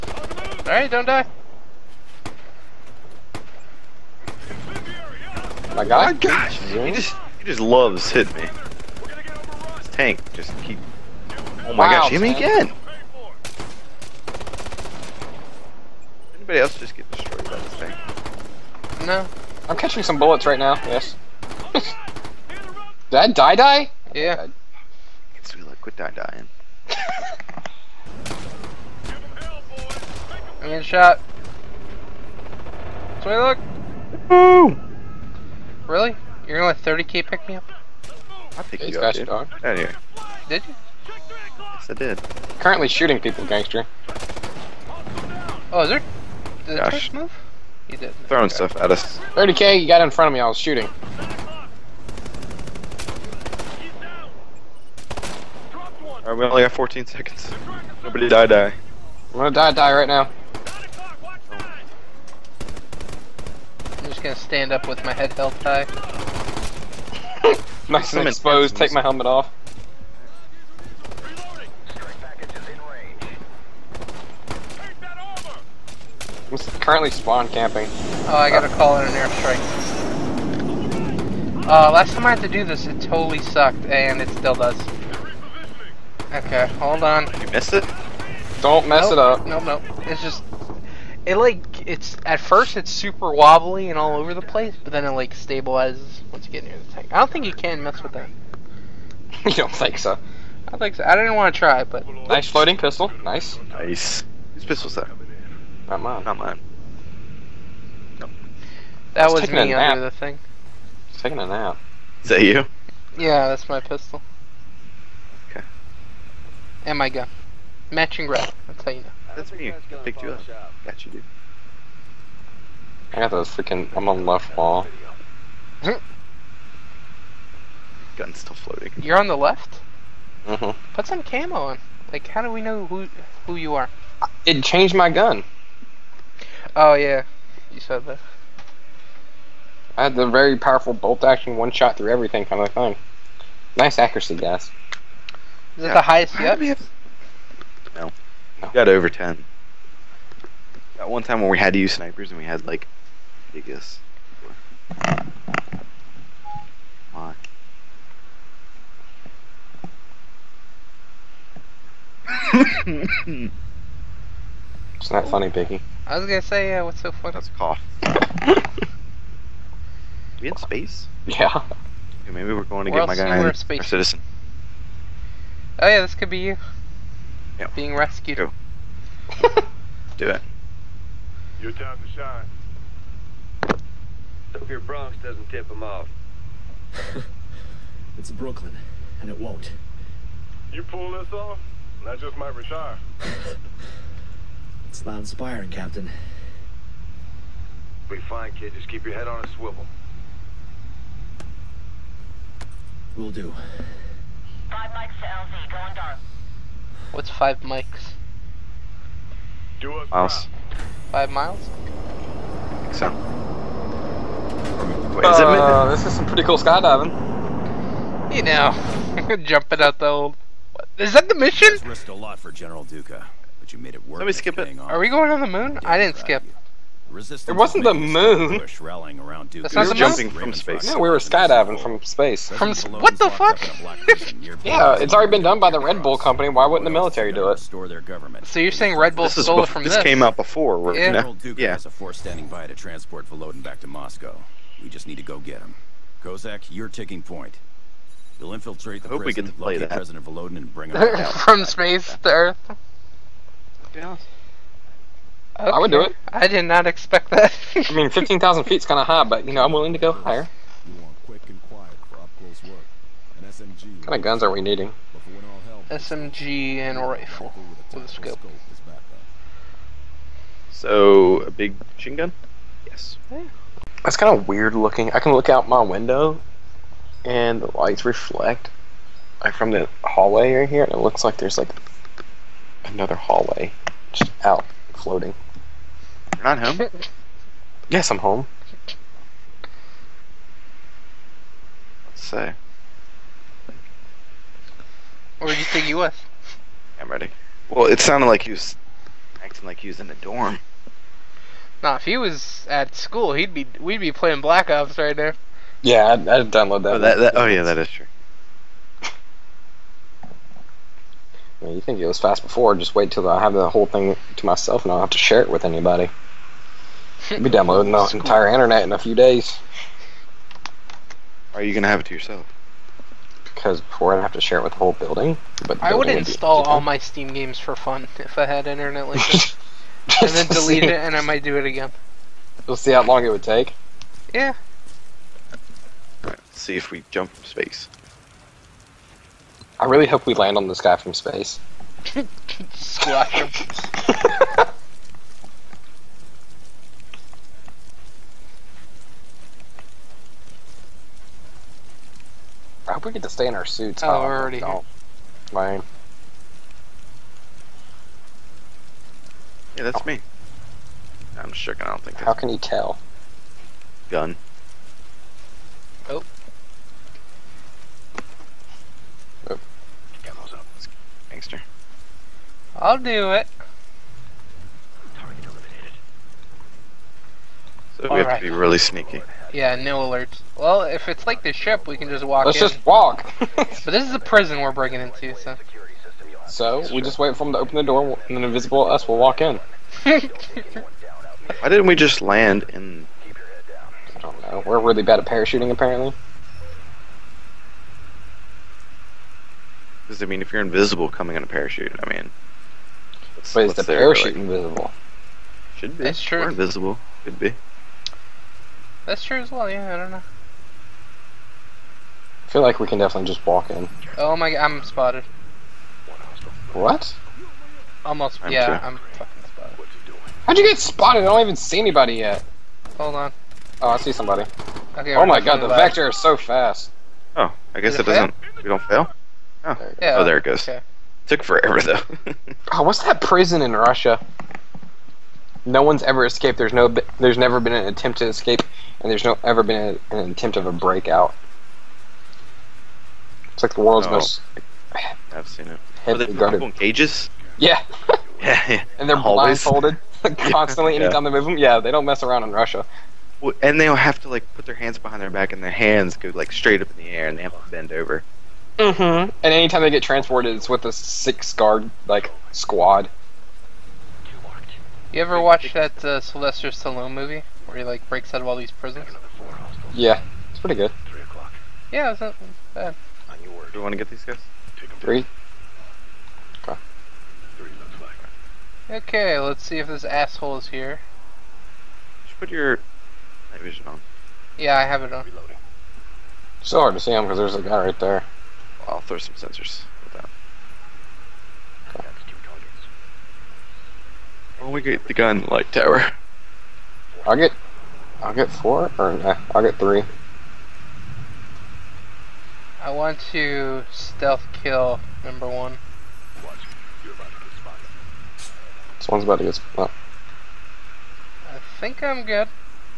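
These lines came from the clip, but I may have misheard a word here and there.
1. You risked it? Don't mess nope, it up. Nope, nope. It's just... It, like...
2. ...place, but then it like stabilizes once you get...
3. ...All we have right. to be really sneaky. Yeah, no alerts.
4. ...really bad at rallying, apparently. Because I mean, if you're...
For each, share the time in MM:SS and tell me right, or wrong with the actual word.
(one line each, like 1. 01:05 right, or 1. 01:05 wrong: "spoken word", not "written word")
1. 01:27 wrong: "missed", not "risked"
2. 01:34 right
3. 06:18 right
4. 06:34 wrong: "parachuting", not "rallying".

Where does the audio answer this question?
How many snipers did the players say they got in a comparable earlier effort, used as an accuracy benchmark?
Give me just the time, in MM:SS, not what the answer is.
02:28.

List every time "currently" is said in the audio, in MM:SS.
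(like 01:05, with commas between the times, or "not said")
00:42, 01:16.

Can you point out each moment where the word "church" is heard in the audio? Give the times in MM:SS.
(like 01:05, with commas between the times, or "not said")
not said.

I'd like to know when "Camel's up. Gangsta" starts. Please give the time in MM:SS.
06:10.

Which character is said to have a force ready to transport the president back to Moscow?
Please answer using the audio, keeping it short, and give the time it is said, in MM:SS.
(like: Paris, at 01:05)
General Duke, at 04:01.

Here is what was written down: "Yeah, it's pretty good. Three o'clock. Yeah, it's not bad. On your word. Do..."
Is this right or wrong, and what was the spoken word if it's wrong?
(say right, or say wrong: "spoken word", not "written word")
right.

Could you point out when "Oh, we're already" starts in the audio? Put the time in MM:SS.
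05:54.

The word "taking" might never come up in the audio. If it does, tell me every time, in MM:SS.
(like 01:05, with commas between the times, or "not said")
01:51, 04:06.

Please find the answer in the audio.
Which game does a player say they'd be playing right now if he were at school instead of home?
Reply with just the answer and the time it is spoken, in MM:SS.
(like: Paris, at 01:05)
Black Ops, at 05:04.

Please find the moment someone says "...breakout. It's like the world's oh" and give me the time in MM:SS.
07:20.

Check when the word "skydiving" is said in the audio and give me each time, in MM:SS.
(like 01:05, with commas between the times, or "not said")
03:36, 03:51.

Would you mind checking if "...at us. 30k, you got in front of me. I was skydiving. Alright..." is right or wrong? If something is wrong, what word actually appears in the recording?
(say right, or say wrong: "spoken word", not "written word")
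wrong: "shooting", not "skydiving".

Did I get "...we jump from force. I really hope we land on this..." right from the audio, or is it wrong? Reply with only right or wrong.
wrong.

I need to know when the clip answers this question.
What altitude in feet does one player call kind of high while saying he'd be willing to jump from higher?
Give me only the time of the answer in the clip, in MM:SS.
04:18.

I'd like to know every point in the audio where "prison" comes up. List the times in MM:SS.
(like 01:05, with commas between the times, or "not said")
04:09, 06:24, 07:13, 07:48.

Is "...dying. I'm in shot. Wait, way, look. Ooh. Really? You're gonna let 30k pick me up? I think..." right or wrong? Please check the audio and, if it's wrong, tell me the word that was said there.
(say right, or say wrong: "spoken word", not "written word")
right.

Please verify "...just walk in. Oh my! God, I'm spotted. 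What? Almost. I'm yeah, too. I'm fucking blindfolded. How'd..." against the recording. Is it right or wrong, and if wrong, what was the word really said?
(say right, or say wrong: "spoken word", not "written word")
wrong: "spotted", not "blindfolded".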